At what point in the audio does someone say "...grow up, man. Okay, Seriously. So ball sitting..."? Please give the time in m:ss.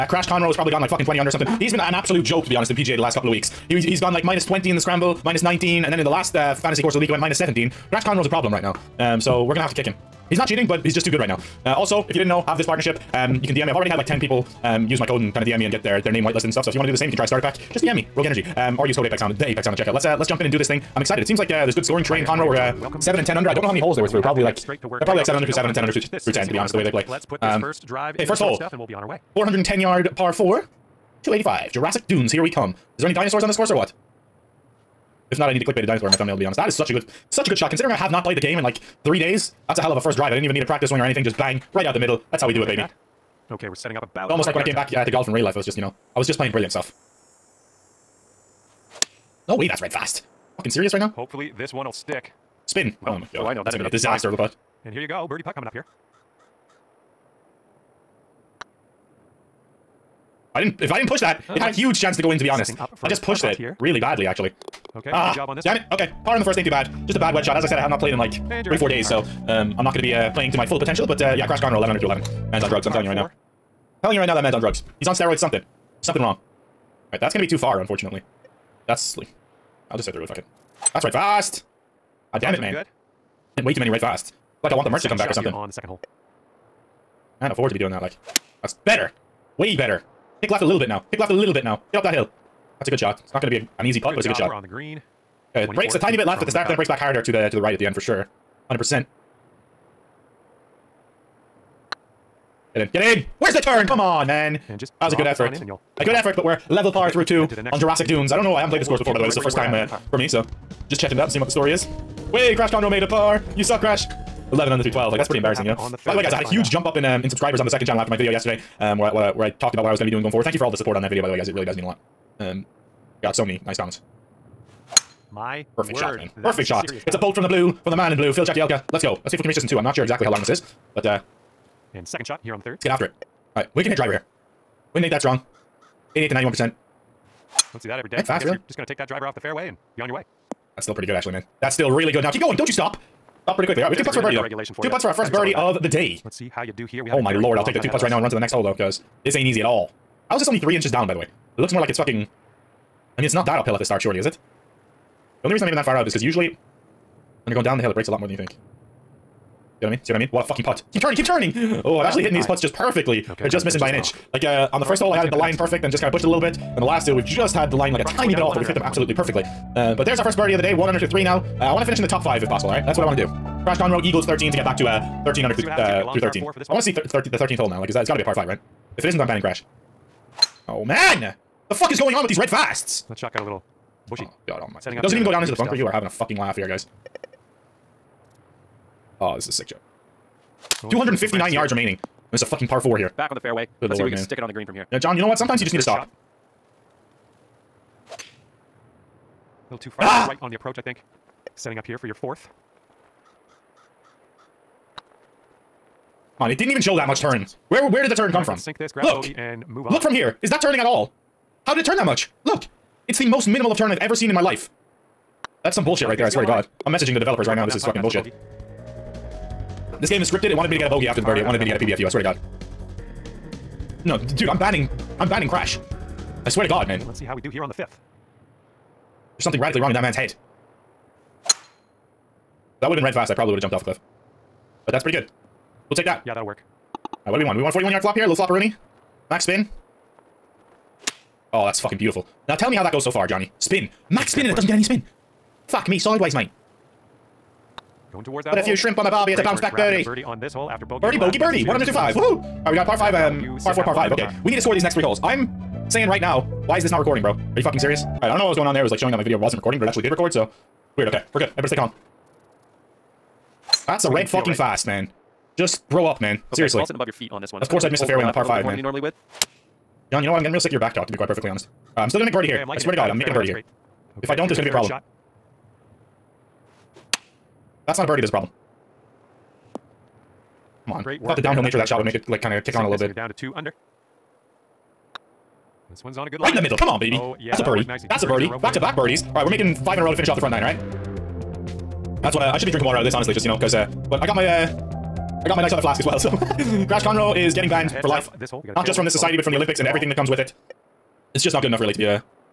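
4:25.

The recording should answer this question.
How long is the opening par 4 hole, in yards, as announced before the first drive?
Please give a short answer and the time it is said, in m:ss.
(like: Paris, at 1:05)
410 yards, at 0:29.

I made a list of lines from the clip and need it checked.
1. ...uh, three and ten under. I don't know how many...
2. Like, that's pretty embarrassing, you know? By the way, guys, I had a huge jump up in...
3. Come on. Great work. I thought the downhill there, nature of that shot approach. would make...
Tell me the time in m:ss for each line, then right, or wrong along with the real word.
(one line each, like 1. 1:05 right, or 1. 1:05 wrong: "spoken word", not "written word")
1. 0:22 wrong: "seven", not "three"
2. 1:55 right
3. 4:40 right.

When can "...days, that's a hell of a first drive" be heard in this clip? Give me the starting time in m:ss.
0:39.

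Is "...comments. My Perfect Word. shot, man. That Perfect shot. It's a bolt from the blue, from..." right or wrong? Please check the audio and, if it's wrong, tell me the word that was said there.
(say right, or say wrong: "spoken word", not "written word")
right.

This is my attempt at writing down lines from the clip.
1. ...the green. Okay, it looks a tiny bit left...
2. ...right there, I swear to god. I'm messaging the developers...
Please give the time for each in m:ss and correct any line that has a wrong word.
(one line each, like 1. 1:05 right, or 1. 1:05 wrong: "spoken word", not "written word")
1. 1:34 wrong: "breaks", not "looks"
2. 3:36 right.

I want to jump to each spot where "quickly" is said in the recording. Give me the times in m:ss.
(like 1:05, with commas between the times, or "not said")
2:23.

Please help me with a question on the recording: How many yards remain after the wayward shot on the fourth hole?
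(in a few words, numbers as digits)
259 yards.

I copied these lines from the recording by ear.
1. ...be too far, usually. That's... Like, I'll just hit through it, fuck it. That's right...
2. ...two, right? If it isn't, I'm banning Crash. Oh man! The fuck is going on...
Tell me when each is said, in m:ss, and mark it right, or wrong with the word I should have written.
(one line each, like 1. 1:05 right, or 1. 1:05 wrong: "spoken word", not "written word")
1. 1:17 wrong: "unfortunately", not "usually"
2. 2:58 wrong: "five", not "two".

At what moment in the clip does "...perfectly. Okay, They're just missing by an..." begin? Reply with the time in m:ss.
2:42.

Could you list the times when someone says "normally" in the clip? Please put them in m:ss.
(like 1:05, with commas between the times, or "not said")
4:28.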